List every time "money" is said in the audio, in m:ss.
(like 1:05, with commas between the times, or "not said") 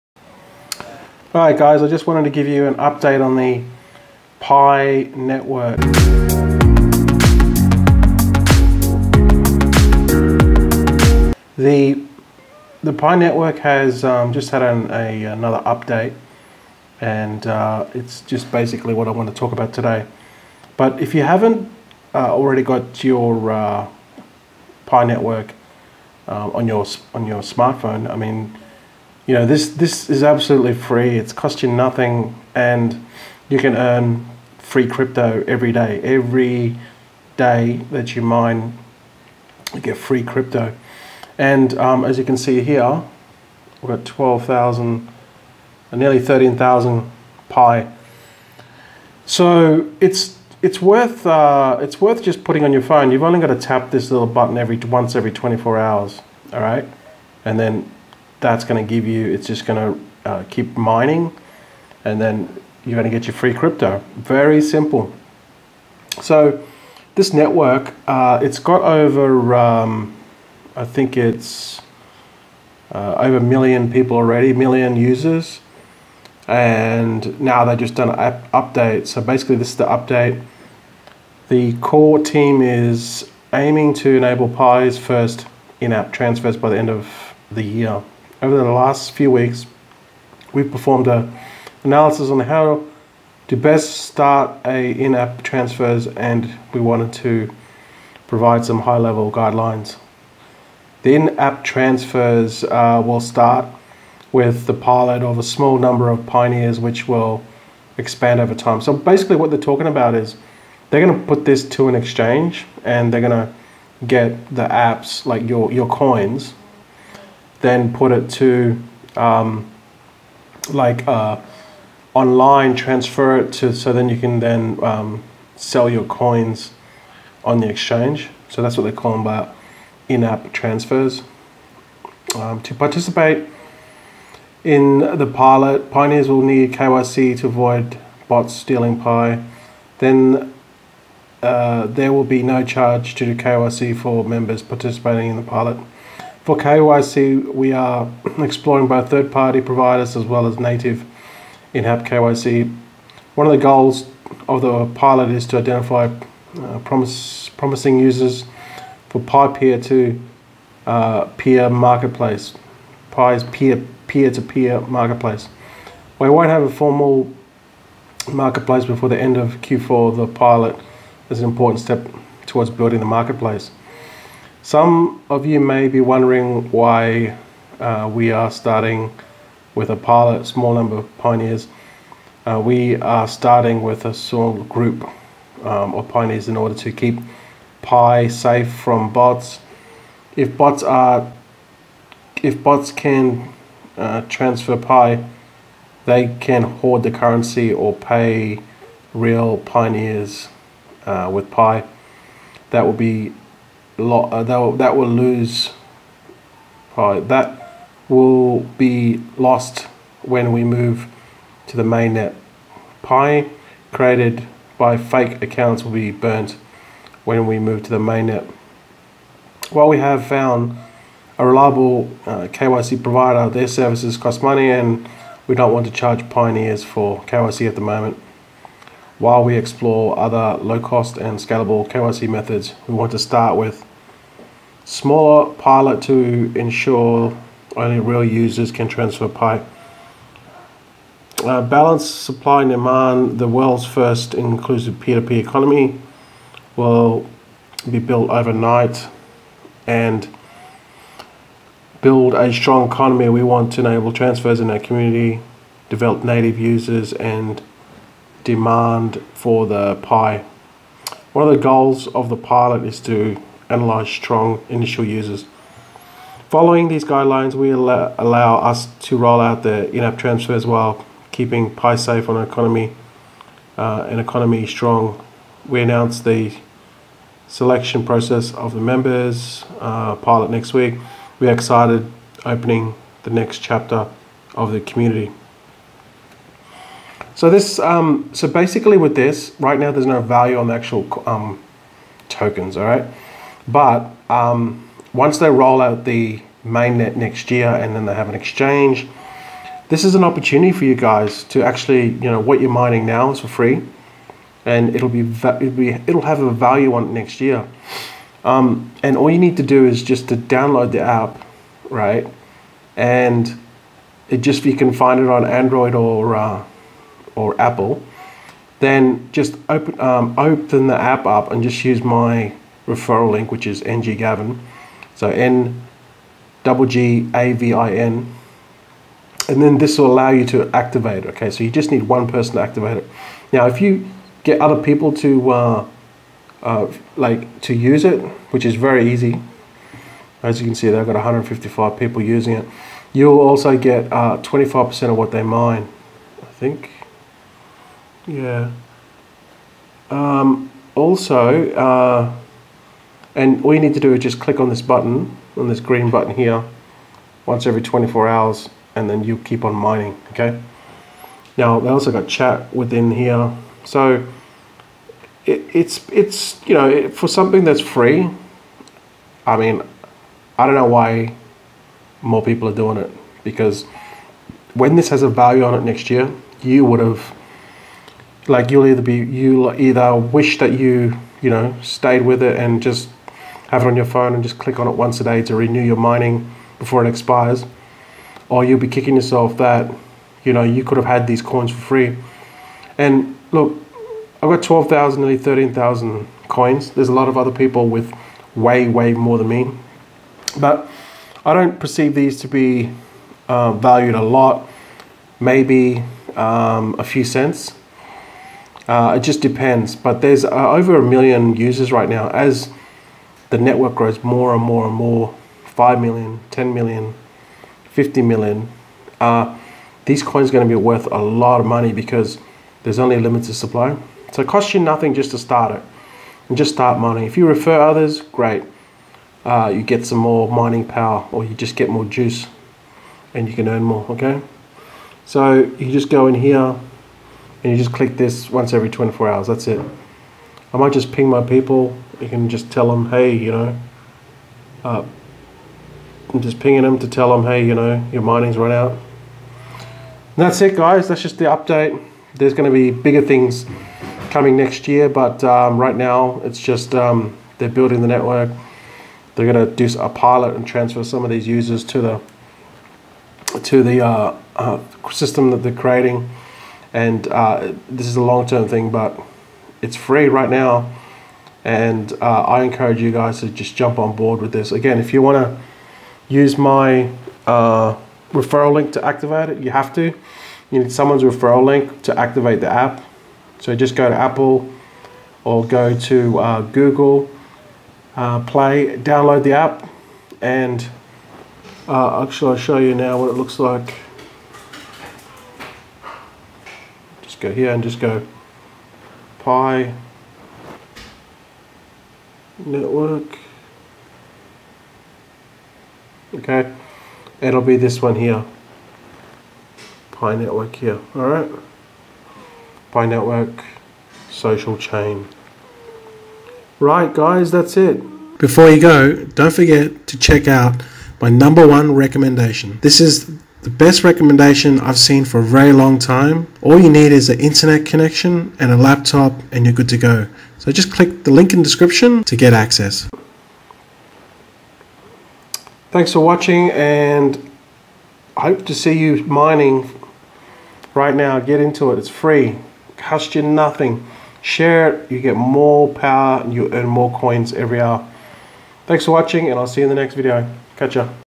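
3:44, 7:01.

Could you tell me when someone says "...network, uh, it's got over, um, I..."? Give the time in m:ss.
1:07.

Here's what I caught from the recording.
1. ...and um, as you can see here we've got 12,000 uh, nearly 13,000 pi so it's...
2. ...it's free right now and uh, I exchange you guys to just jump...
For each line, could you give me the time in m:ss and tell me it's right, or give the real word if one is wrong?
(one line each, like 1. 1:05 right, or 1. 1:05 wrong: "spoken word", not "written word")
1. 0:41 right
2. 7:49 wrong: "encourage", not "exchange".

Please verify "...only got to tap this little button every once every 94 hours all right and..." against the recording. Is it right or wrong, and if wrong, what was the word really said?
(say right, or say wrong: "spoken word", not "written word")
wrong: "24", not "94".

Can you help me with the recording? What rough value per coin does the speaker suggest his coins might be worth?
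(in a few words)
a few cents.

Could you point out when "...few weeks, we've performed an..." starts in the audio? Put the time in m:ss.
1:29.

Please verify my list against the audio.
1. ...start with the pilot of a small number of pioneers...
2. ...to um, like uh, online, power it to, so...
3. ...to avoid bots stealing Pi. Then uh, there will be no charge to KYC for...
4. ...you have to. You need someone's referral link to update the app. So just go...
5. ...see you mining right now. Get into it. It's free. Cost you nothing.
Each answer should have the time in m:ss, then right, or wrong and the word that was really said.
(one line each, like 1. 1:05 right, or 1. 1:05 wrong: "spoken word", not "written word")
1. 1:43 right
2. 1:58 wrong: "transfer", not "power"
3. 2:17 right
4. 7:59 wrong: "activate", not "update"
5. 8:58 right.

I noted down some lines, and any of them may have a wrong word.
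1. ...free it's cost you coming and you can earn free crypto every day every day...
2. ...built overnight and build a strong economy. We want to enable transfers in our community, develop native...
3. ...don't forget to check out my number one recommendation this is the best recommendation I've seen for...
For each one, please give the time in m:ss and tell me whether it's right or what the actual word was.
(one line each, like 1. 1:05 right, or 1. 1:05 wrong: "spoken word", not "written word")
1. 0:30 wrong: "nothing", not "coming"
2. 4:07 right
3. 8:39 right.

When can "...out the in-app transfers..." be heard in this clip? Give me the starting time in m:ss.
4:29.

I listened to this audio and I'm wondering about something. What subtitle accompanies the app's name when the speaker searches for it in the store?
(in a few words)
social chain.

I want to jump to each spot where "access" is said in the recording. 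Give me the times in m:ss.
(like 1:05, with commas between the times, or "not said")
8:52.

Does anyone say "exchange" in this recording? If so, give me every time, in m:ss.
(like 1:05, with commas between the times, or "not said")
1:51, 2:07, 4:58.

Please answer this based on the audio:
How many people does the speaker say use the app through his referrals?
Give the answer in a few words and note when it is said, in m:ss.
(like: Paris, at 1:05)
155, at 5:41.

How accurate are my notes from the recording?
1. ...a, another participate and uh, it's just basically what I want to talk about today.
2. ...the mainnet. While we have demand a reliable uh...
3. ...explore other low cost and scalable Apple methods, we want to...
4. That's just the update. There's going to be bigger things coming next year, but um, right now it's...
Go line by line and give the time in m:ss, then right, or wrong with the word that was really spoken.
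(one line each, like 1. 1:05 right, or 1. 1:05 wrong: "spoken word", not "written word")
1. 0:14 wrong: "update", not "participate"
2. 3:37 wrong: "found", not "demand"
3. 3:49 wrong: "KYC", not "Apple"
4. 7:31 right.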